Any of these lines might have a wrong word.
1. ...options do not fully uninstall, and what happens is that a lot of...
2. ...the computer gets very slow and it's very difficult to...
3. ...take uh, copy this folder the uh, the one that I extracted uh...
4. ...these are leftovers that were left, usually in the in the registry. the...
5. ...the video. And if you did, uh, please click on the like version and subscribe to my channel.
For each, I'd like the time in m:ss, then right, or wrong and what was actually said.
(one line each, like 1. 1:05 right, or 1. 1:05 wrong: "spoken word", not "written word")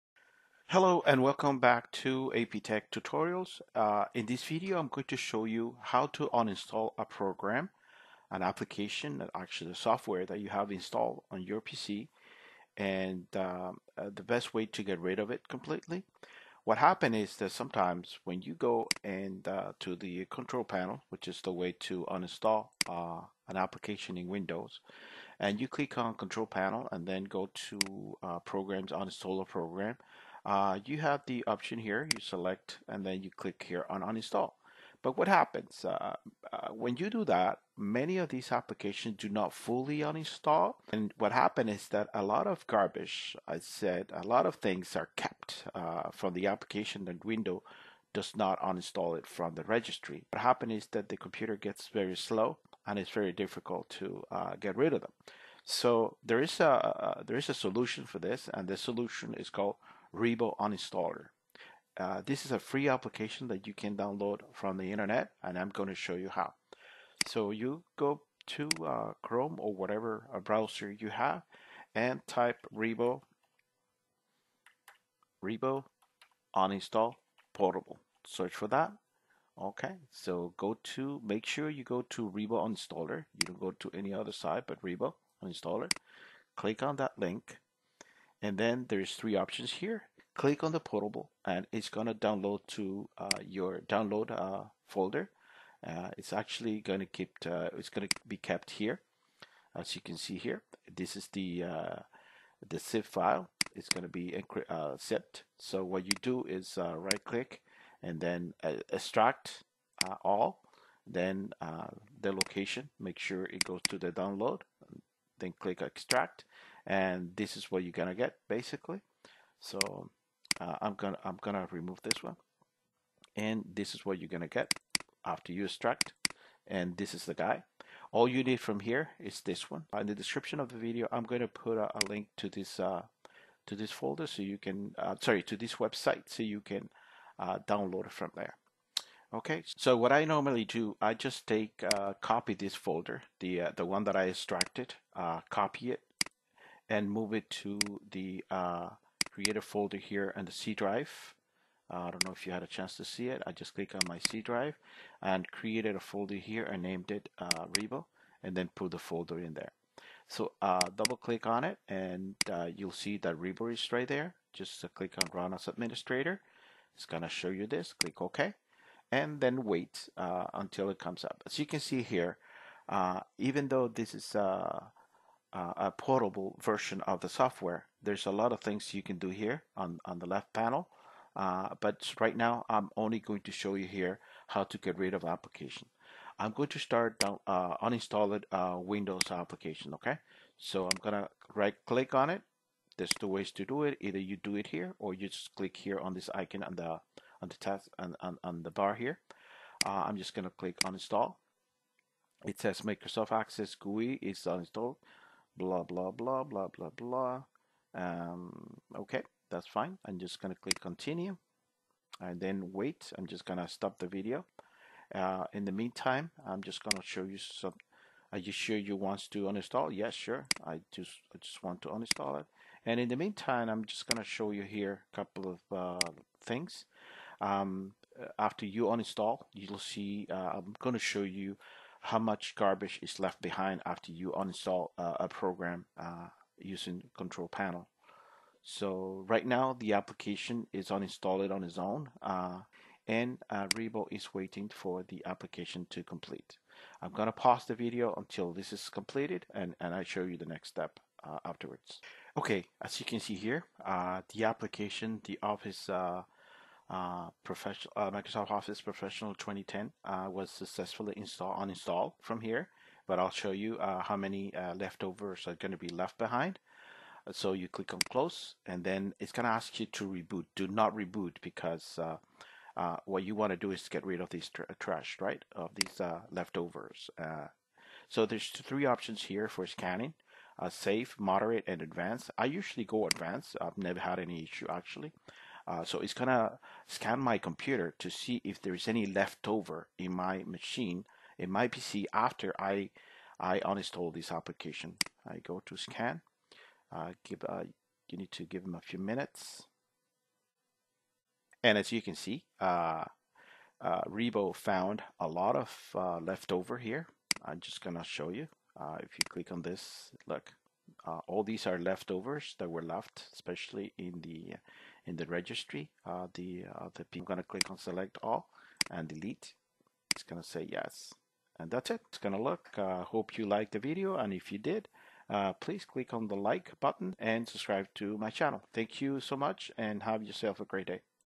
1. 0:38 wrong: "applications", not "options"
2. 0:51 right
3. 2:21 right
4. 5:11 wrong: "especially", not "usually"
5. 5:23 wrong: "button", not "version".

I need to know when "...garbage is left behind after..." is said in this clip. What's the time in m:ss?
3:52.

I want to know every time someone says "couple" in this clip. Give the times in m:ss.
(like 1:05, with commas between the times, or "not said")
3:45.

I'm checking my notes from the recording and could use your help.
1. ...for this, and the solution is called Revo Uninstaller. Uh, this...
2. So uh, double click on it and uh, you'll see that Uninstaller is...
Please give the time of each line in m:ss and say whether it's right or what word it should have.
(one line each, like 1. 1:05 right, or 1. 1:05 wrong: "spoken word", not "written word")
1. 0:58 right
2. 2:40 wrong: "Revo", not "Uninstaller".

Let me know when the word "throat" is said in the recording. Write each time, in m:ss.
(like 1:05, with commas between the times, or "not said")
not said.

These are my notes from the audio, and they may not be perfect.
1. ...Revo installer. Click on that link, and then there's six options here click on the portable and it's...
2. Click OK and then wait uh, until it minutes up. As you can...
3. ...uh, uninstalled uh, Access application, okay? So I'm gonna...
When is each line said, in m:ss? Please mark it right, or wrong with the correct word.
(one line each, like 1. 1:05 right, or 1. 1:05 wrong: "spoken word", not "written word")
1. 1:24 wrong: "three", not "six"
2. 2:47 wrong: "comes", not "minutes"
3. 3:07 wrong: "Windows", not "Access".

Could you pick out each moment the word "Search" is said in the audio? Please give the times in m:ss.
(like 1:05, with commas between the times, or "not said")
1:18.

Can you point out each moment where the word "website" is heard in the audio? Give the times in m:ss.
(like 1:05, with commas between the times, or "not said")
2:15.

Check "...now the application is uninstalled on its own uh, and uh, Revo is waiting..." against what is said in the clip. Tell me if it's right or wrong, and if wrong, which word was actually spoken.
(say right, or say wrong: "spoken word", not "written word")
right.